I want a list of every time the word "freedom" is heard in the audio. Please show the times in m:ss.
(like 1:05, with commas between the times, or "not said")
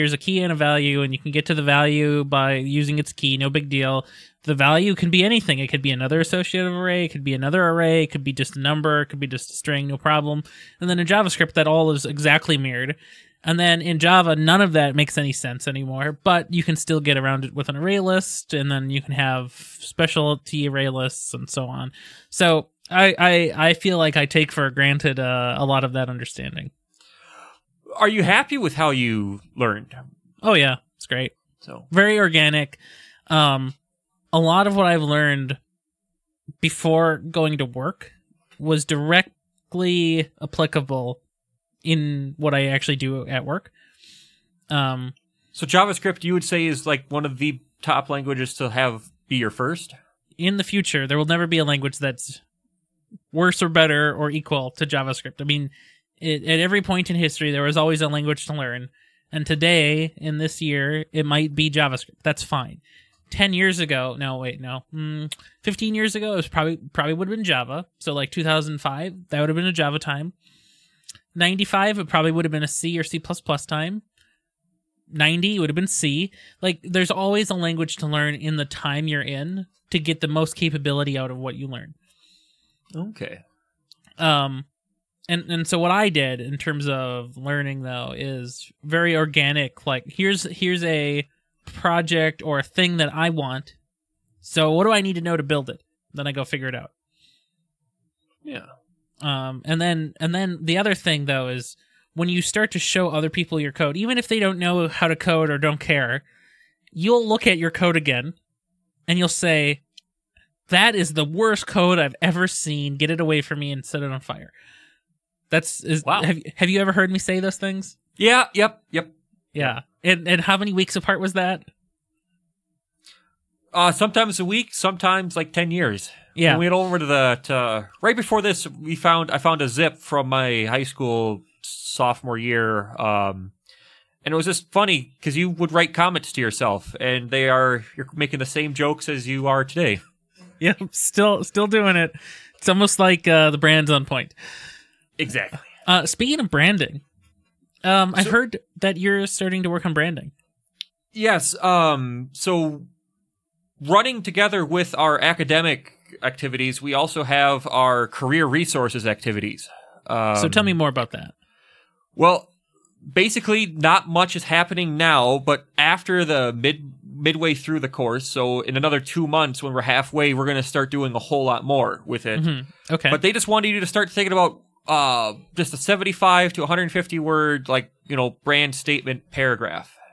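not said.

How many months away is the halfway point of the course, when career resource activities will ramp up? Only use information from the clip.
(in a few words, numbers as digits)
2.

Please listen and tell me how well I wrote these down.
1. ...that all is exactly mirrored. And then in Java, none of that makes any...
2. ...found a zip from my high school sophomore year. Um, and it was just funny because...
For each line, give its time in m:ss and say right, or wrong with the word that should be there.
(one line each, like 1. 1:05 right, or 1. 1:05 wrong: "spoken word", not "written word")
1. 0:11 right
2. 2:09 right.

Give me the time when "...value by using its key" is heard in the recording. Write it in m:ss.
0:01.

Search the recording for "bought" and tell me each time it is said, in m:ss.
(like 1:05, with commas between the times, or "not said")
not said.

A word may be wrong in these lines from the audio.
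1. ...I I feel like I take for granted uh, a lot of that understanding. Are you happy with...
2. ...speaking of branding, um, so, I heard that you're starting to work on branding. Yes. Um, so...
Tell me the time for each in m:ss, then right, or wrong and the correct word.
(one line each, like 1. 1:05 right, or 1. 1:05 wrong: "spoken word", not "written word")
1. 0:23 right
2. 2:26 right.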